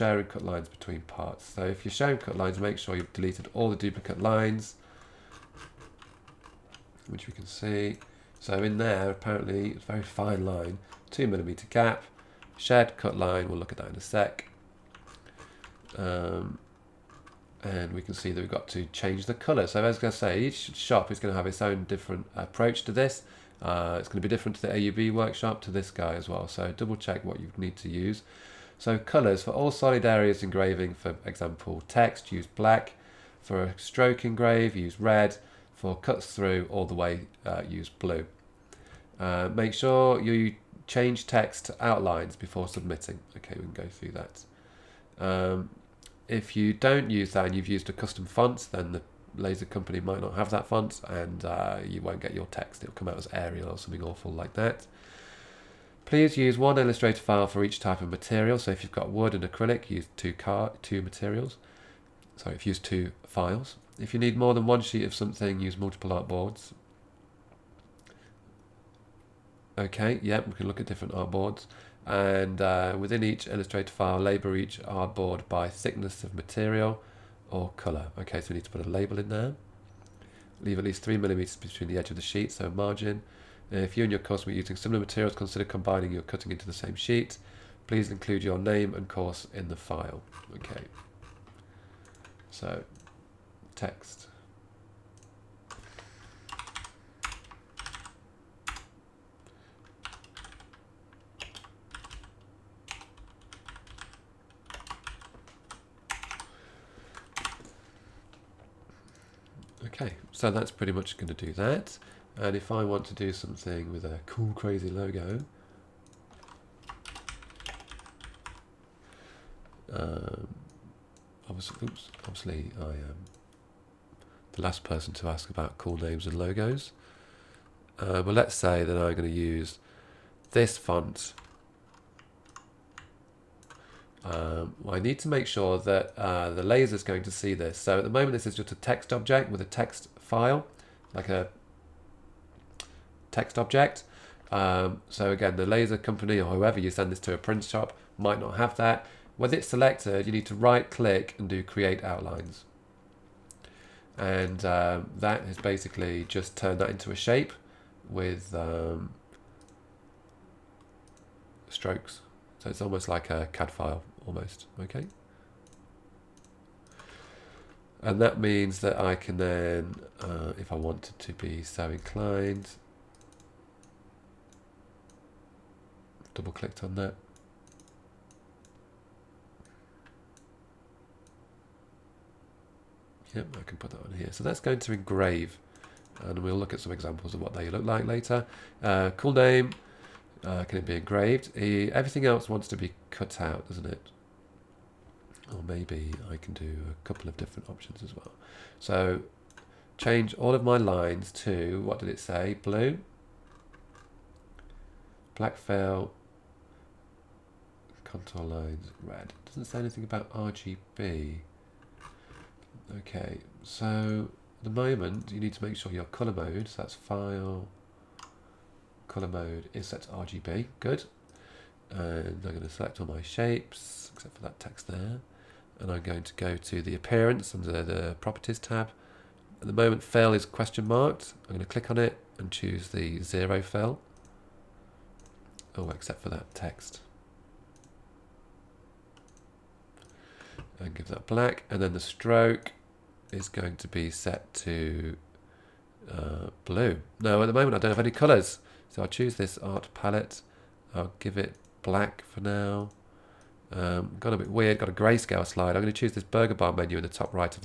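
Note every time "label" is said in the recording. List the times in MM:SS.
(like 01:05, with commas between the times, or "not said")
01:14, 01:18.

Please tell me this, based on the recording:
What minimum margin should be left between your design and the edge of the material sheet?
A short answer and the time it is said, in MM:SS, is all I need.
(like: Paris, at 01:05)
3 millimeters, at 01:21.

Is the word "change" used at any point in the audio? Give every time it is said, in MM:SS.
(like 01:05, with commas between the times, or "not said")
00:18, 00:40, 03:19.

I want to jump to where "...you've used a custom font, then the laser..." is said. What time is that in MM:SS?
00:47.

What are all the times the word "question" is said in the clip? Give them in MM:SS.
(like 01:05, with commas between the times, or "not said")
03:50.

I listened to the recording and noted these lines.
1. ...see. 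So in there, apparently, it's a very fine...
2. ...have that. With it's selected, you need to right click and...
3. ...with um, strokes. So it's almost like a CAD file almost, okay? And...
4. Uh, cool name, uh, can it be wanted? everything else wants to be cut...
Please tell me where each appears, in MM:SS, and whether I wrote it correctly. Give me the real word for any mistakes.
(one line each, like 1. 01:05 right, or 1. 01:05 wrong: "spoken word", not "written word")
1. 00:07 right
2. 02:28 right
3. 02:38 right
4. 03:08 wrong: "engraved", not "wanted".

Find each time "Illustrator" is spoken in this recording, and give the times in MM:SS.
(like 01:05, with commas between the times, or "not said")
00:56, 01:13.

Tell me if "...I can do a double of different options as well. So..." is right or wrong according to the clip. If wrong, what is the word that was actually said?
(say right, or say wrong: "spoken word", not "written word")
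wrong: "couple", not "double".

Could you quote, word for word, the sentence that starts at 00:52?
It'll come out as Arial or something awful like that.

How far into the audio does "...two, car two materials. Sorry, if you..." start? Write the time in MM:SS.
01:00.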